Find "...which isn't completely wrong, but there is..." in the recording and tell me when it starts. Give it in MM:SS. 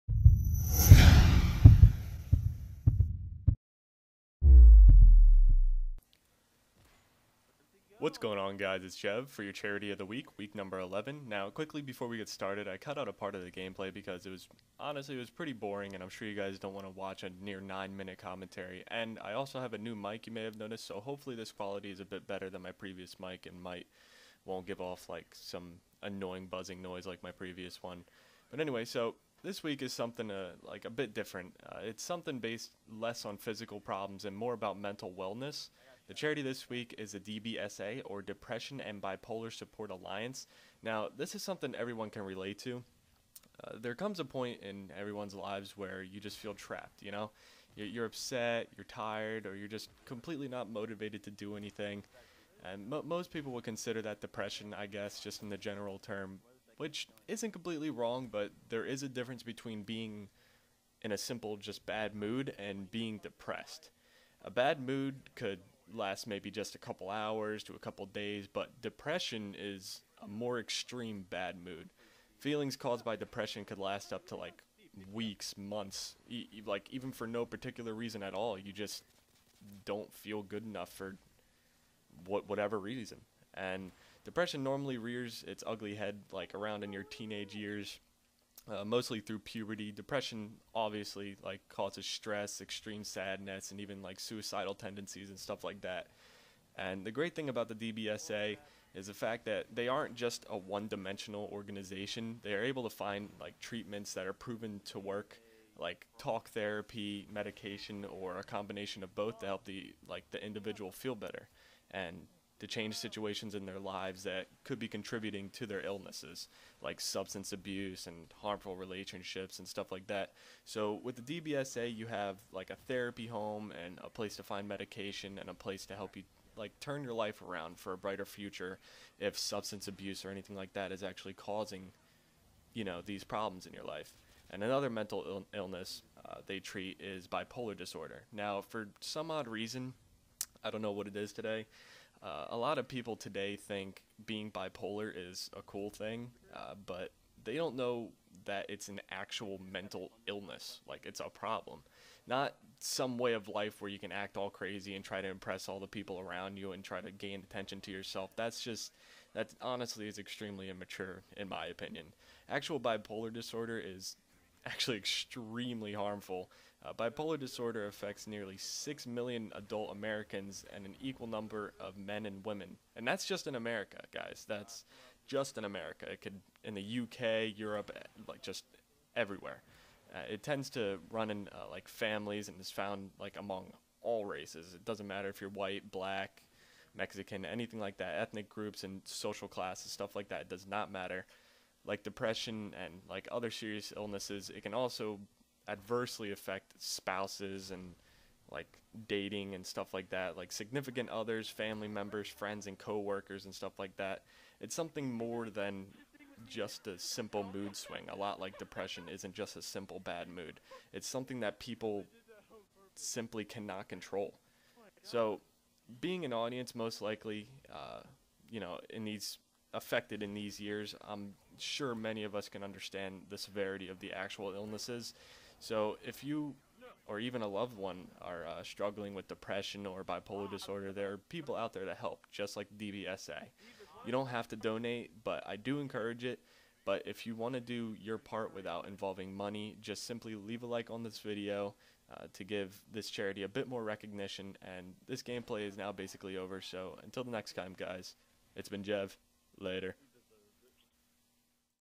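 00:56.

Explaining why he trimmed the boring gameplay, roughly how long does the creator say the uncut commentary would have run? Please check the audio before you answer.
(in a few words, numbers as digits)
9 minutes.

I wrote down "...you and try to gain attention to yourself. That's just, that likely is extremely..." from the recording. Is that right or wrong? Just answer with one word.
wrong.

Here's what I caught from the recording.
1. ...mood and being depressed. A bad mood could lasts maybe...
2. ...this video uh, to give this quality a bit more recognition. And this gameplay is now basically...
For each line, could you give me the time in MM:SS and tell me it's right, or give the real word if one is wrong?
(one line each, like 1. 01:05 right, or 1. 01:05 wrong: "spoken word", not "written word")
1. 01:02 right
2. 04:01 wrong: "charity", not "quality".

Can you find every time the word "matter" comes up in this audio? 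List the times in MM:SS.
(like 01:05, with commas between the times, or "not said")
03:05, 03:10.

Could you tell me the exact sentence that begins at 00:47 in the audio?
You're, you're upset, you're tired, or you're just completely not motivated to do anything.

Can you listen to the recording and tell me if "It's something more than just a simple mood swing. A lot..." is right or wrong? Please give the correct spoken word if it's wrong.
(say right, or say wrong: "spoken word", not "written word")
right.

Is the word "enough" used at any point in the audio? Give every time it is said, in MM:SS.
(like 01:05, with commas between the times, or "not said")
01:20.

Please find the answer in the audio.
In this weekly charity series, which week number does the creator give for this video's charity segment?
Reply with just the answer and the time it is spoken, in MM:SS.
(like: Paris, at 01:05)
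11, at 00:10.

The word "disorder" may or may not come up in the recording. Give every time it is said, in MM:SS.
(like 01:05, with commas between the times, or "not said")
02:17, 02:43, 02:47, 03:50.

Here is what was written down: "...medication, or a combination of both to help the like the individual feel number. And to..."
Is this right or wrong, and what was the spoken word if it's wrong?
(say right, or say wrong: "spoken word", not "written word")
wrong: "better", not "number".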